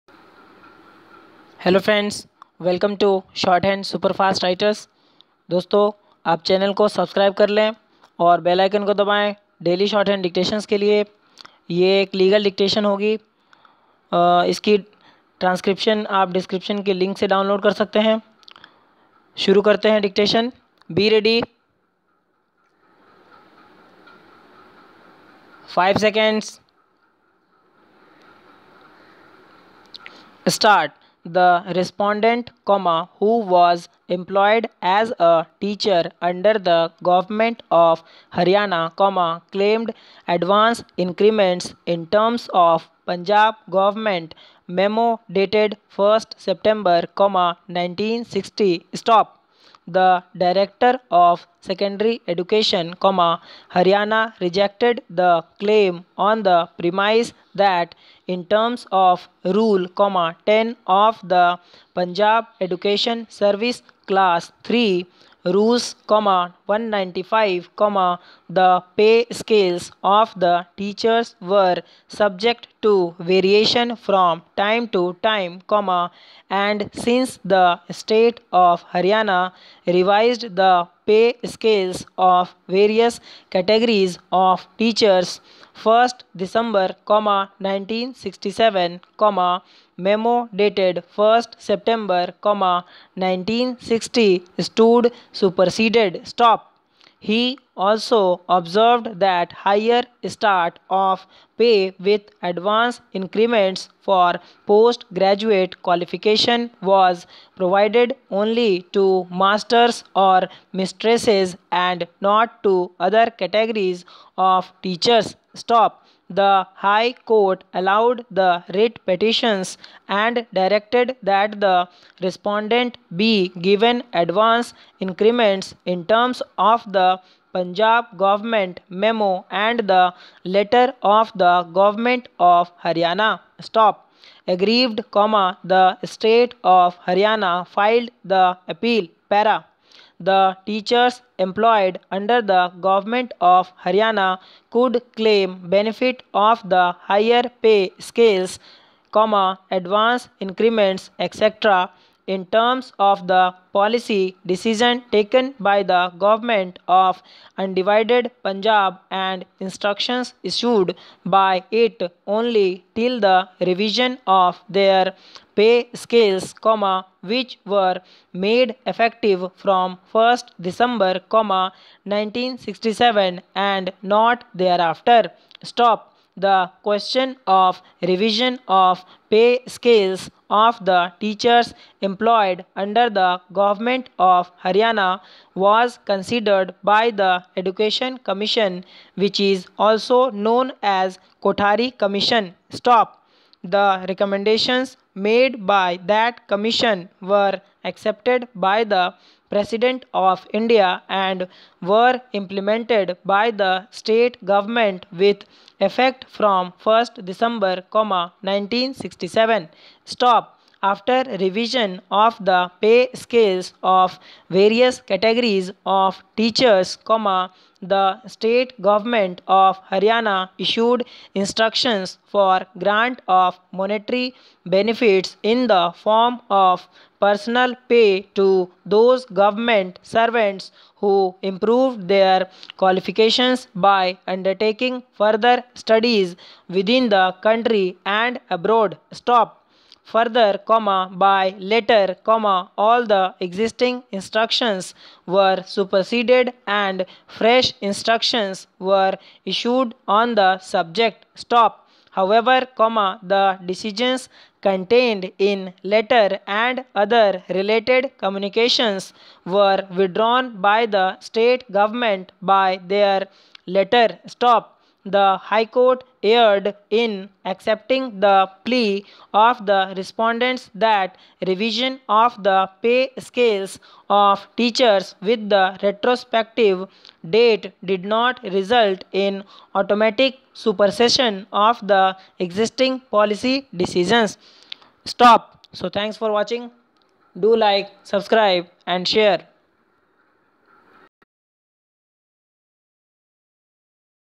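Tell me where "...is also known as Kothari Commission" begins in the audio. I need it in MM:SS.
03:09.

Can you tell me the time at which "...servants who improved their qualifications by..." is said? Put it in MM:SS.
03:50.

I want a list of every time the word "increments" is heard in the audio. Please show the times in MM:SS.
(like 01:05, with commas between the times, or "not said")
00:40, 01:43, 02:04, 02:30.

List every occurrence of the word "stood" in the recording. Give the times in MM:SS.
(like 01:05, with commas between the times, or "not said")
01:34.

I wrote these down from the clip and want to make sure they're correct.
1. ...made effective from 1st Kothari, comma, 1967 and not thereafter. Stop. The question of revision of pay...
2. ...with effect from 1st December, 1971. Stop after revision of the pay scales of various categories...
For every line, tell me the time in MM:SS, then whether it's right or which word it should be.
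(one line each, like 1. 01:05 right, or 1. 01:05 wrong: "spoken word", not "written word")
1. 02:48 wrong: "December", not "Kothari"
2. 03:25 wrong: "1967", not "1971".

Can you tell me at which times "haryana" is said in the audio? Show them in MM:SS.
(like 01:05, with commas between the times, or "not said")
00:38, 00:53, 01:18, 02:12, 02:17, 02:23, 03:04, 03:39.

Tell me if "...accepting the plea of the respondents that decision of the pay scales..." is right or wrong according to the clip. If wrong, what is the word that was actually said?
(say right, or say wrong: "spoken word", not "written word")
wrong: "revision", not "decision".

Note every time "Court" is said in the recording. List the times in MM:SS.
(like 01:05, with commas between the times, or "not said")
01:57, 04:25.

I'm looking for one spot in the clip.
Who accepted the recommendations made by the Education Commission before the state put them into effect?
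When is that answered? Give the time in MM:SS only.
03:19.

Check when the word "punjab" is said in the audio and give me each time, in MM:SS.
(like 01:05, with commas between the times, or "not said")
00:43, 01:01, 02:07, 02:38.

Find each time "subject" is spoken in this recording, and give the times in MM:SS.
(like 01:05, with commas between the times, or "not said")
01:12, 04:10.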